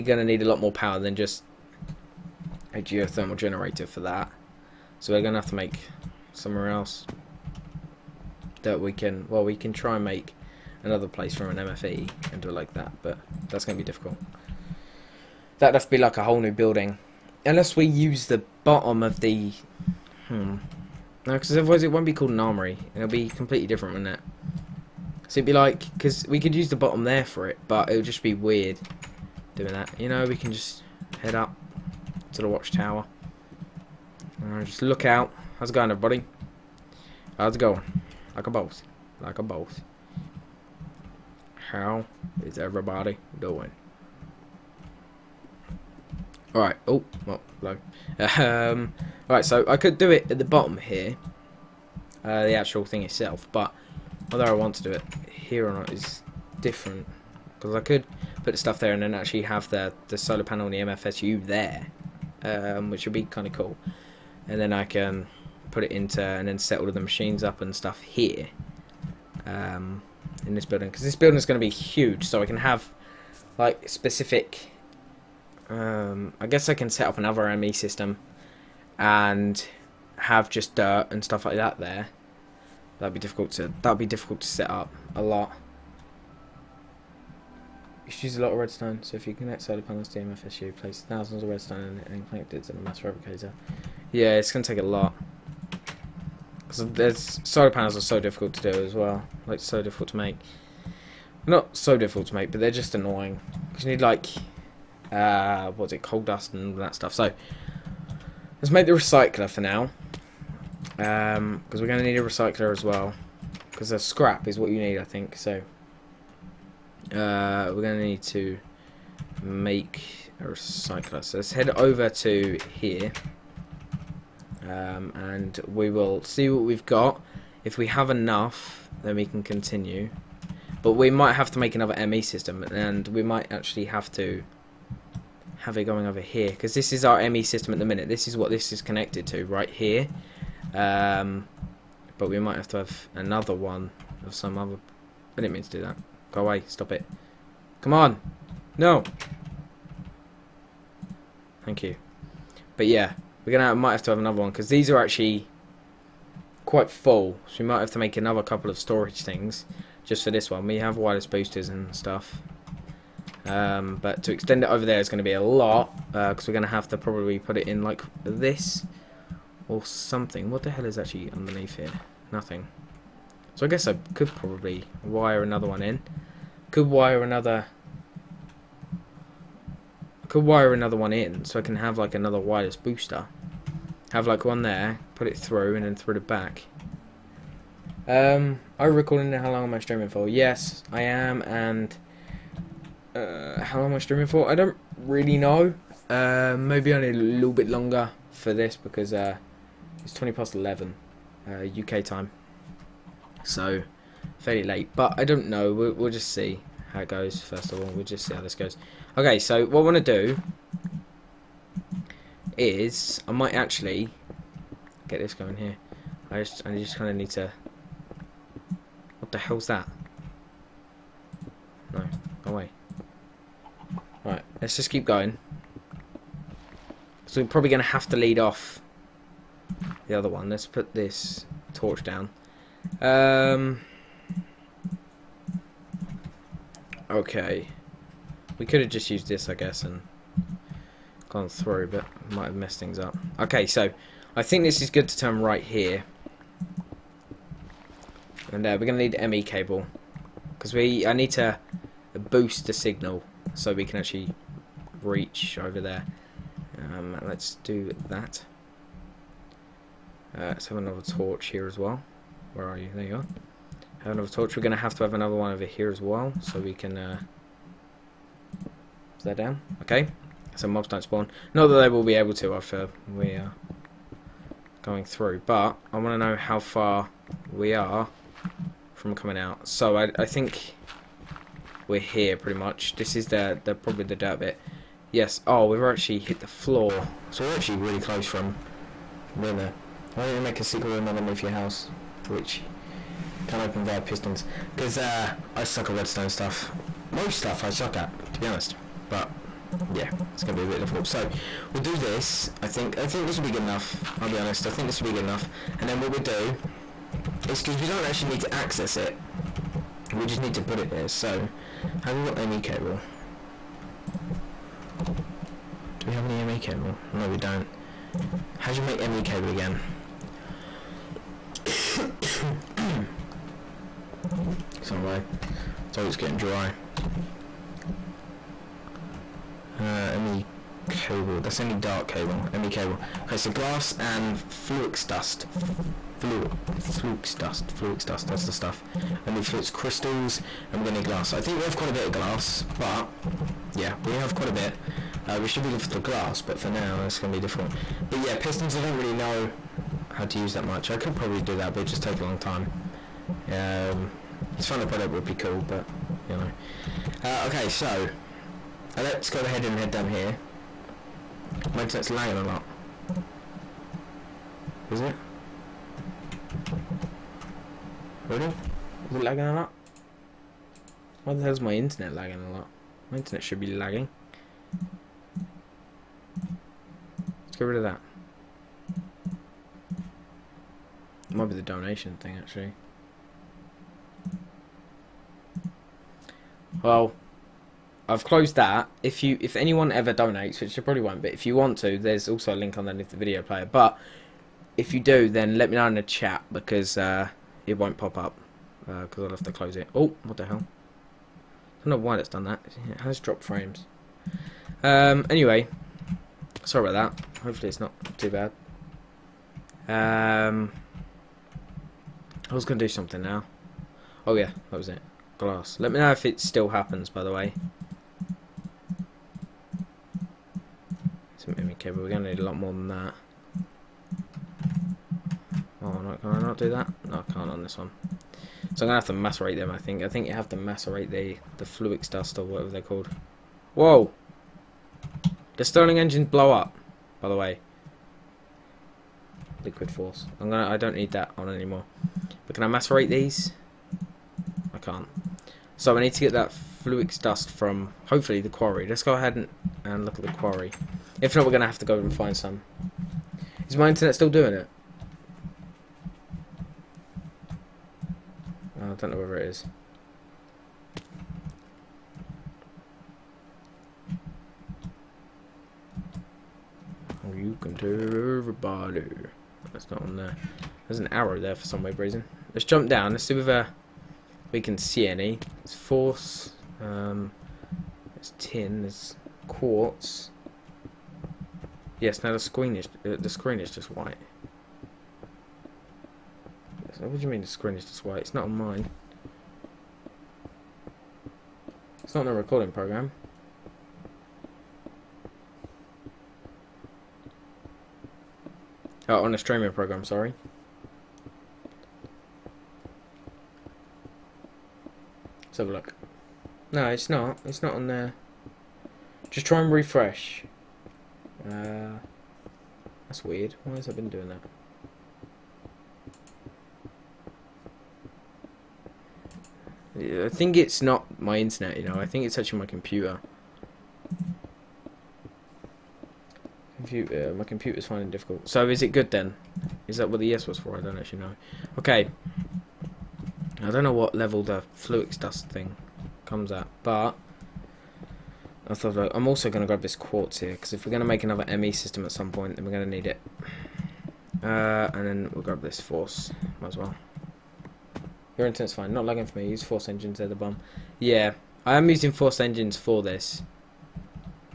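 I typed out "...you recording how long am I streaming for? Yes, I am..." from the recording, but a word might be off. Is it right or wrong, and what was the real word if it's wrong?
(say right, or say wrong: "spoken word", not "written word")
right.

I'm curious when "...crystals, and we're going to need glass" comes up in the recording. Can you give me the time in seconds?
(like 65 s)
339 s.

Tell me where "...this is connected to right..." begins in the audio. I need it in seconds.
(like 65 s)
138 s.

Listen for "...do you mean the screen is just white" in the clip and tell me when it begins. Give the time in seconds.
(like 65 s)
487 s.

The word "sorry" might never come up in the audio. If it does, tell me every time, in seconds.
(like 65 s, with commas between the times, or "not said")
325 s, 406 s, 500 s.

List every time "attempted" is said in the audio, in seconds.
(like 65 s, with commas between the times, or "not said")
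not said.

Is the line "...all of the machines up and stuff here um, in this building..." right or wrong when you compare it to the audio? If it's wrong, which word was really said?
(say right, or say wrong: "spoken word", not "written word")
right.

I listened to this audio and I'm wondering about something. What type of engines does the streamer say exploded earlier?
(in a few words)
Stirling engines.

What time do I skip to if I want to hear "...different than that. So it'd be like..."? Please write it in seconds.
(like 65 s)
23 s.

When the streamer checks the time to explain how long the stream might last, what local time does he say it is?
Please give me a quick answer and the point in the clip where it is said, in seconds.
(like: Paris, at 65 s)
20 past 11, at 200 s.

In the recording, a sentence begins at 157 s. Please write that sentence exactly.
So we might have to make another couple of storage things just for this one.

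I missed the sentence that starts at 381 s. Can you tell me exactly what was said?
It might be the donation thing actually.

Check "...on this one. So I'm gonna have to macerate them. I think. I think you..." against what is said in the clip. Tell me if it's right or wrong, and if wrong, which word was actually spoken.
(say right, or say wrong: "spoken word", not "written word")
right.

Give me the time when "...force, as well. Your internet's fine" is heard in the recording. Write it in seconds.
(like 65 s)
545 s.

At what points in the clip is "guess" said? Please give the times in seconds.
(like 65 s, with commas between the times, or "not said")
76 s, 173 s, 239 s.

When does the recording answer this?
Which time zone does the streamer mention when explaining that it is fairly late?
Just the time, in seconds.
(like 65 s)
201 s.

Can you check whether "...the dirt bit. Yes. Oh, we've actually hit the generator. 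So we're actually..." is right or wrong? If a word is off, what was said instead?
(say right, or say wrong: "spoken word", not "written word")
wrong: "floor", not "generator".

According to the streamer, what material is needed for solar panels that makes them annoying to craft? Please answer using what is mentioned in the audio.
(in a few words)
coal dust.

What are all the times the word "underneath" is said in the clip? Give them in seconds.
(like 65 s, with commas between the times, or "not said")
171 s, 291 s, 392 s.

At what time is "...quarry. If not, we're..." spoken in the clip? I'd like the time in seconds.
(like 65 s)
450 s.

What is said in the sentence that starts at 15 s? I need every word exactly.
That'd have to be like a whole new building.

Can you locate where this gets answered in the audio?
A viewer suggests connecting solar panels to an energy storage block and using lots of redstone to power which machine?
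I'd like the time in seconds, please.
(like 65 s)
92 s.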